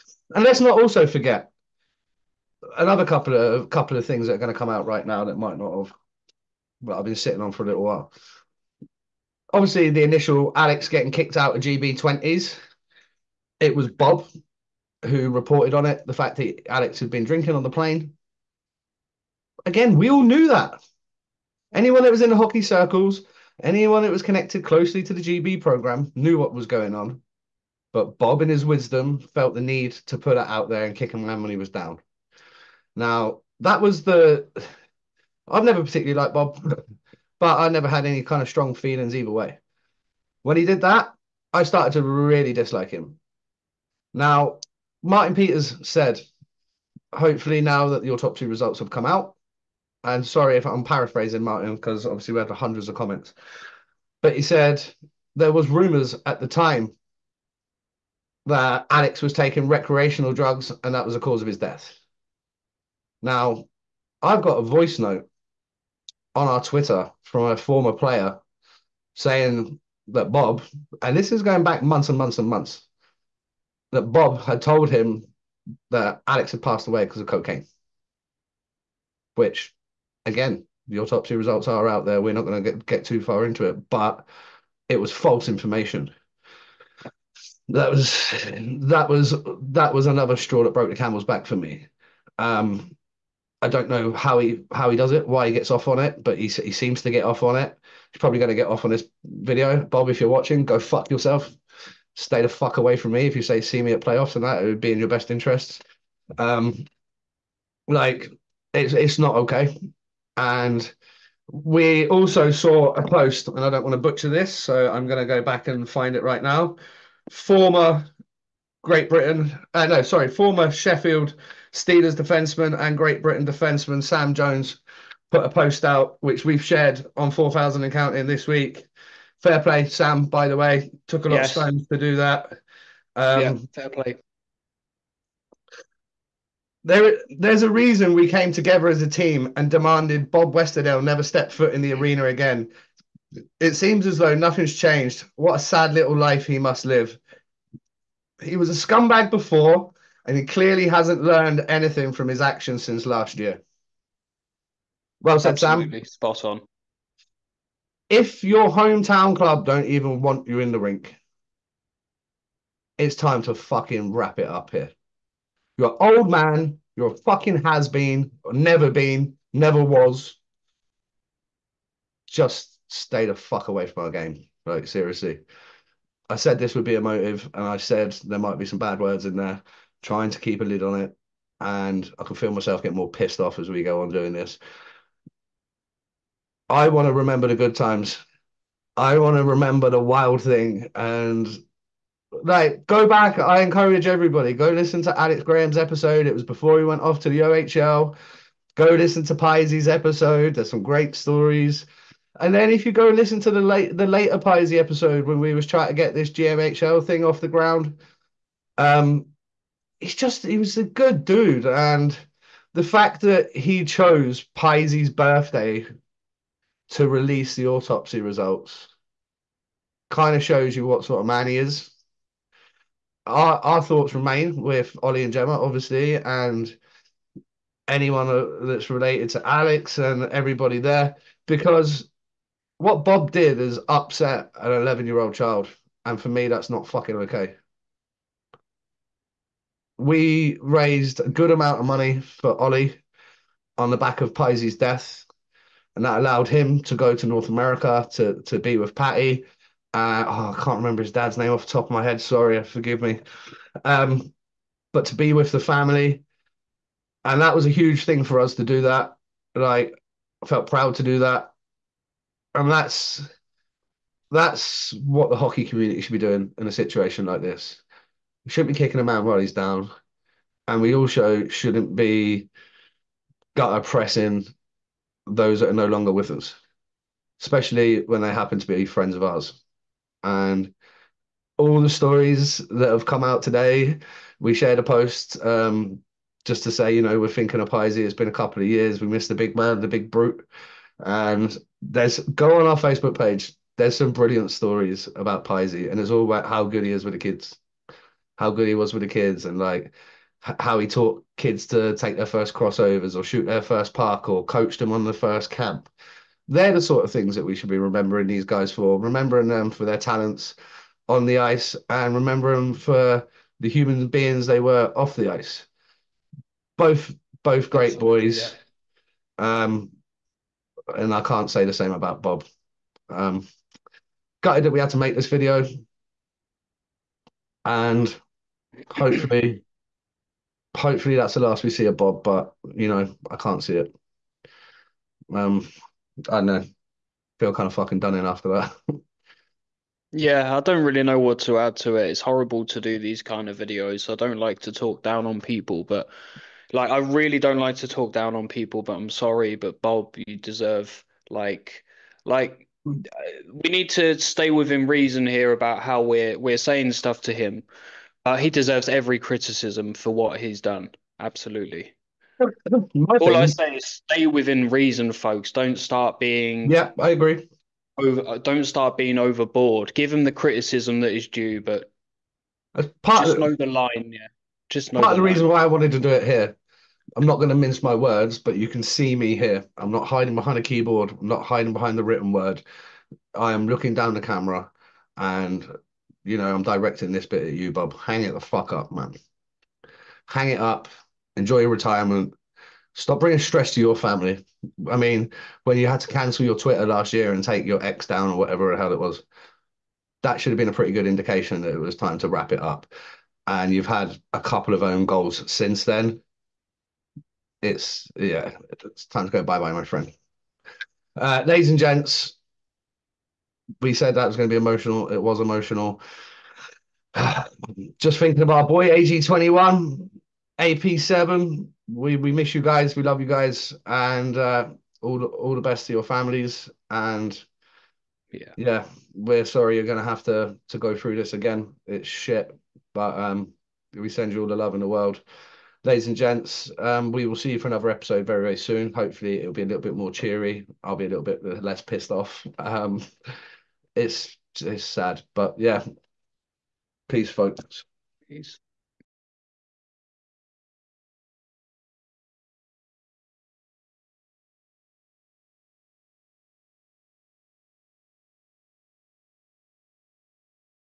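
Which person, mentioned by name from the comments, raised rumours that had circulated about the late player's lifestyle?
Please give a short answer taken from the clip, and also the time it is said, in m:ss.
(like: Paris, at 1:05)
Martin Peters, at 0:45.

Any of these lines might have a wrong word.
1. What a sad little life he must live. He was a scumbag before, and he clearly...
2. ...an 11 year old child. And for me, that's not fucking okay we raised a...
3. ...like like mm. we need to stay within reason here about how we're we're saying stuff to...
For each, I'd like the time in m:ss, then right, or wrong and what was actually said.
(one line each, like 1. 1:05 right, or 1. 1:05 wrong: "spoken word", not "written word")
1. 2:25 right
2. 3:54 right
3. 5:51 right.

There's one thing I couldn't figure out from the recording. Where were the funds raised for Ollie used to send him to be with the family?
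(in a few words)
North America.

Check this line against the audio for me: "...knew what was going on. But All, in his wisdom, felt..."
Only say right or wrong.
wrong.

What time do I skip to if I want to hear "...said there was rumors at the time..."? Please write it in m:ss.
0:54.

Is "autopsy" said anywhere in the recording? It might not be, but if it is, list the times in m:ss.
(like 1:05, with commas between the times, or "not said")
0:48, 1:20, 3:37.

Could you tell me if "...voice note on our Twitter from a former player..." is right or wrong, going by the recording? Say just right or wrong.
right.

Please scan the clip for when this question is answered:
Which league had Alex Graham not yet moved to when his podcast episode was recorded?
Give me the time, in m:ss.
3:17.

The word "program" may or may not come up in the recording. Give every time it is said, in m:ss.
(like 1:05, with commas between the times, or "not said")
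0:25.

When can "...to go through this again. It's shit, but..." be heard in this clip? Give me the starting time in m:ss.
7:10.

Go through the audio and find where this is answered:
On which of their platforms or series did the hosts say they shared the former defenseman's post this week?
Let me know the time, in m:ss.
2:07.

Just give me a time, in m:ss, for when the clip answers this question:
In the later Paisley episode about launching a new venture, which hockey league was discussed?
3:26.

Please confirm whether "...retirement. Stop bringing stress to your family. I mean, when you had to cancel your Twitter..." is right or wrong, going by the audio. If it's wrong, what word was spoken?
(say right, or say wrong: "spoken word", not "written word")
right.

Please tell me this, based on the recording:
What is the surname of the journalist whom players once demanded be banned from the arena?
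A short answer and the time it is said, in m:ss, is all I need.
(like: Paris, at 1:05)
Westerdale, at 2:20.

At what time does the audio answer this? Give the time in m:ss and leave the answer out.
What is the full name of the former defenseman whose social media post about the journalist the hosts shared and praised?
2:04.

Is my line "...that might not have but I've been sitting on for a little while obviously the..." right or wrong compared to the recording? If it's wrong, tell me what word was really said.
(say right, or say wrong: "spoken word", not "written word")
right.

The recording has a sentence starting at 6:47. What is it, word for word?
It's yeah, it's time to go bye bye, my friend.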